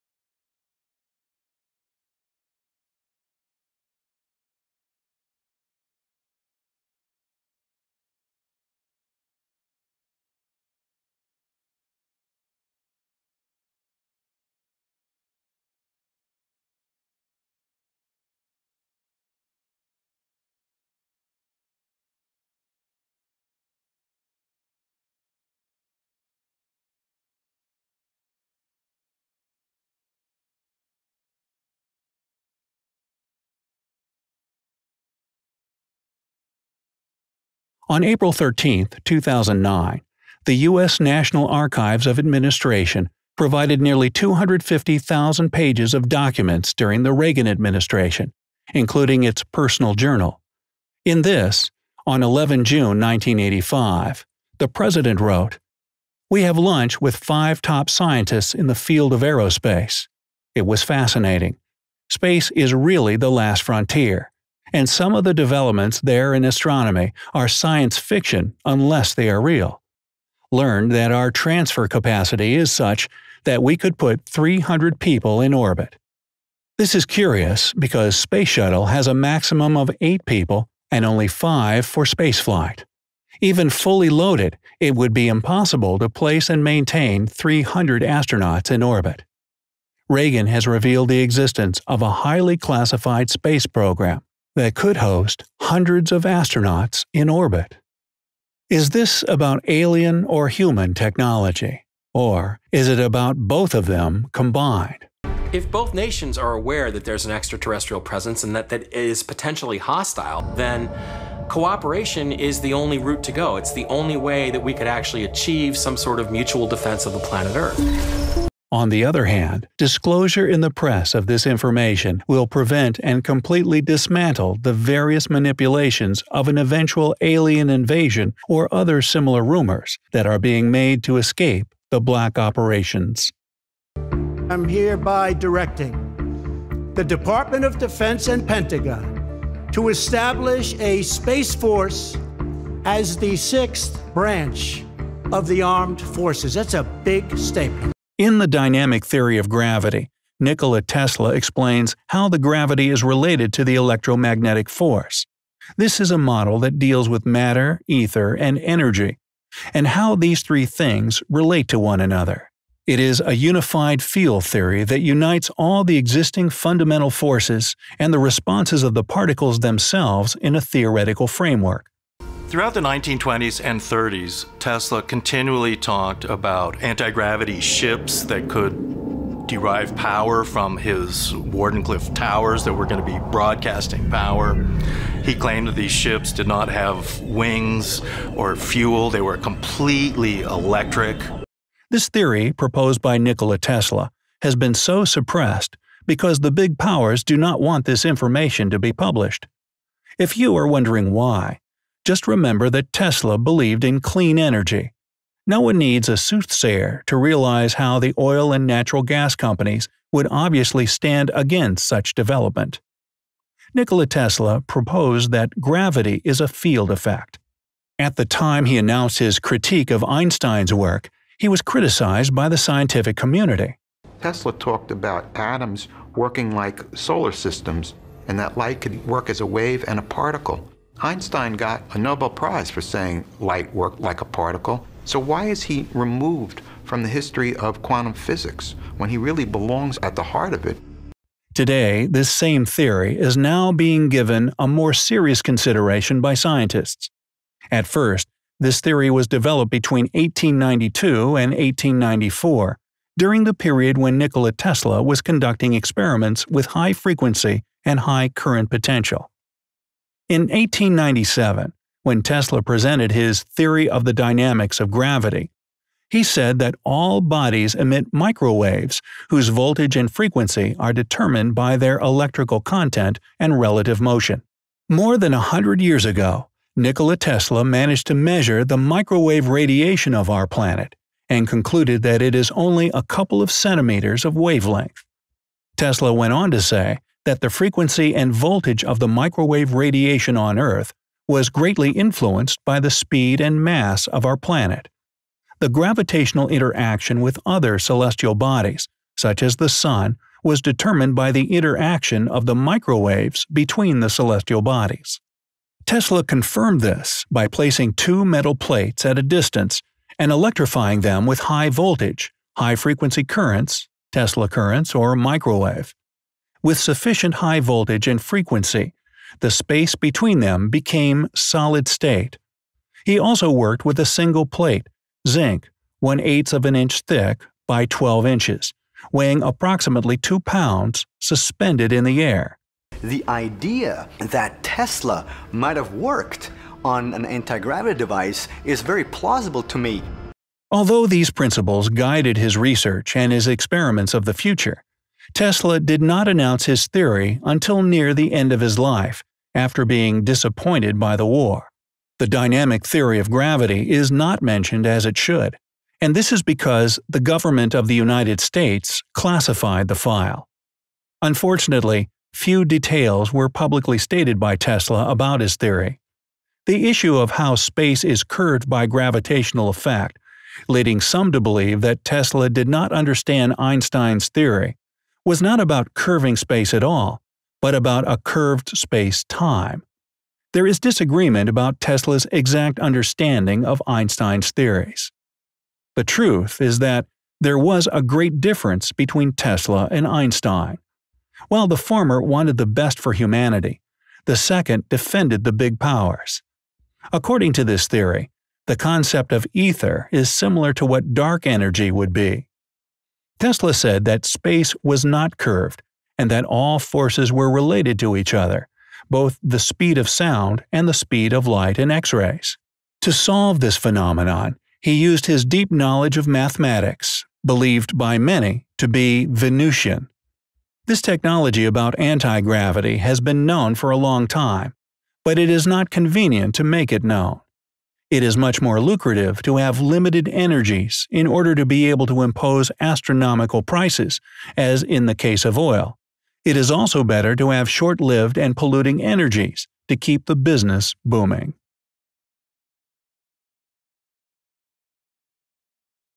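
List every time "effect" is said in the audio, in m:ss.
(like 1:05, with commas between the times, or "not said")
3:36, 6:09.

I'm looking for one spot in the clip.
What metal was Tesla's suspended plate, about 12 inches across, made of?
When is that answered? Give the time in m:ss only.
5:25.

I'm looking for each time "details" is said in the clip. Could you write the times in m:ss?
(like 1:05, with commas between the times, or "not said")
6:02.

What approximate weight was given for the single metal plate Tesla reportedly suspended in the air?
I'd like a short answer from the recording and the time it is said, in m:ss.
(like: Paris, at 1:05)
2 pounds, at 5:30.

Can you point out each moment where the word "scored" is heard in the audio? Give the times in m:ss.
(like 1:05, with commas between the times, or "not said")
not said.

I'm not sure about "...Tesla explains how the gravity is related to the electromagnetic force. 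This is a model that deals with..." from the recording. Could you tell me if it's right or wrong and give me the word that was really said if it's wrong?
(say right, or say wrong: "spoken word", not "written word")
right.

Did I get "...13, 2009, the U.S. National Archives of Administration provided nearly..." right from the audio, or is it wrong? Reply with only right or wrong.
right.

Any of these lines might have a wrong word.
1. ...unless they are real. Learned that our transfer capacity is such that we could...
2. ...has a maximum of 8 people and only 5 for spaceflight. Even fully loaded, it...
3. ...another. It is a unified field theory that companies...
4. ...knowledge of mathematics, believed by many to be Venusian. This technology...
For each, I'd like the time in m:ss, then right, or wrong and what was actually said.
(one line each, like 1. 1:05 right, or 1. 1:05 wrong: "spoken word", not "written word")
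1. 1:08 right
2. 1:18 right
3. 2:41 wrong: "unites", not "companies"
4. 6:55 right.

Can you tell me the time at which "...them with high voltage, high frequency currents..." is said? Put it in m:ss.
5:11.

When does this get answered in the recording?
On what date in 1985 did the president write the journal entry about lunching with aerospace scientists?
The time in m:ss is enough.
0:52.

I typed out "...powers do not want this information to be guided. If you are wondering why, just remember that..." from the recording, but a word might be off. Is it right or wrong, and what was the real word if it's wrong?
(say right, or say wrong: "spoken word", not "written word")
wrong: "published", not "guided".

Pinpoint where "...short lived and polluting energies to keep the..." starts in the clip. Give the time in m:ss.
7:17.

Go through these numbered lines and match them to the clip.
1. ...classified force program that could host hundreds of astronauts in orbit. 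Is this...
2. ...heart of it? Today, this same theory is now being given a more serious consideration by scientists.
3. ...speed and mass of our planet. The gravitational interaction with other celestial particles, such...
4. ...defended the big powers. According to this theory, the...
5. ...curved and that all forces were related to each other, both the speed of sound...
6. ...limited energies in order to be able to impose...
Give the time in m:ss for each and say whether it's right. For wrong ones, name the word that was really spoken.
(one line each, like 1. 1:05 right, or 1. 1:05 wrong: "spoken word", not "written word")
1. 1:32 wrong: "space", not "force"
2. 4:00 right
3. 4:52 wrong: "bodies", not "particles"
4. 6:34 right
5. 6:45 right
6. 7:09 right.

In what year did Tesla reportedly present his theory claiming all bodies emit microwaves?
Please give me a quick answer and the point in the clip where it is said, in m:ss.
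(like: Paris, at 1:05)
1897, at 4:20.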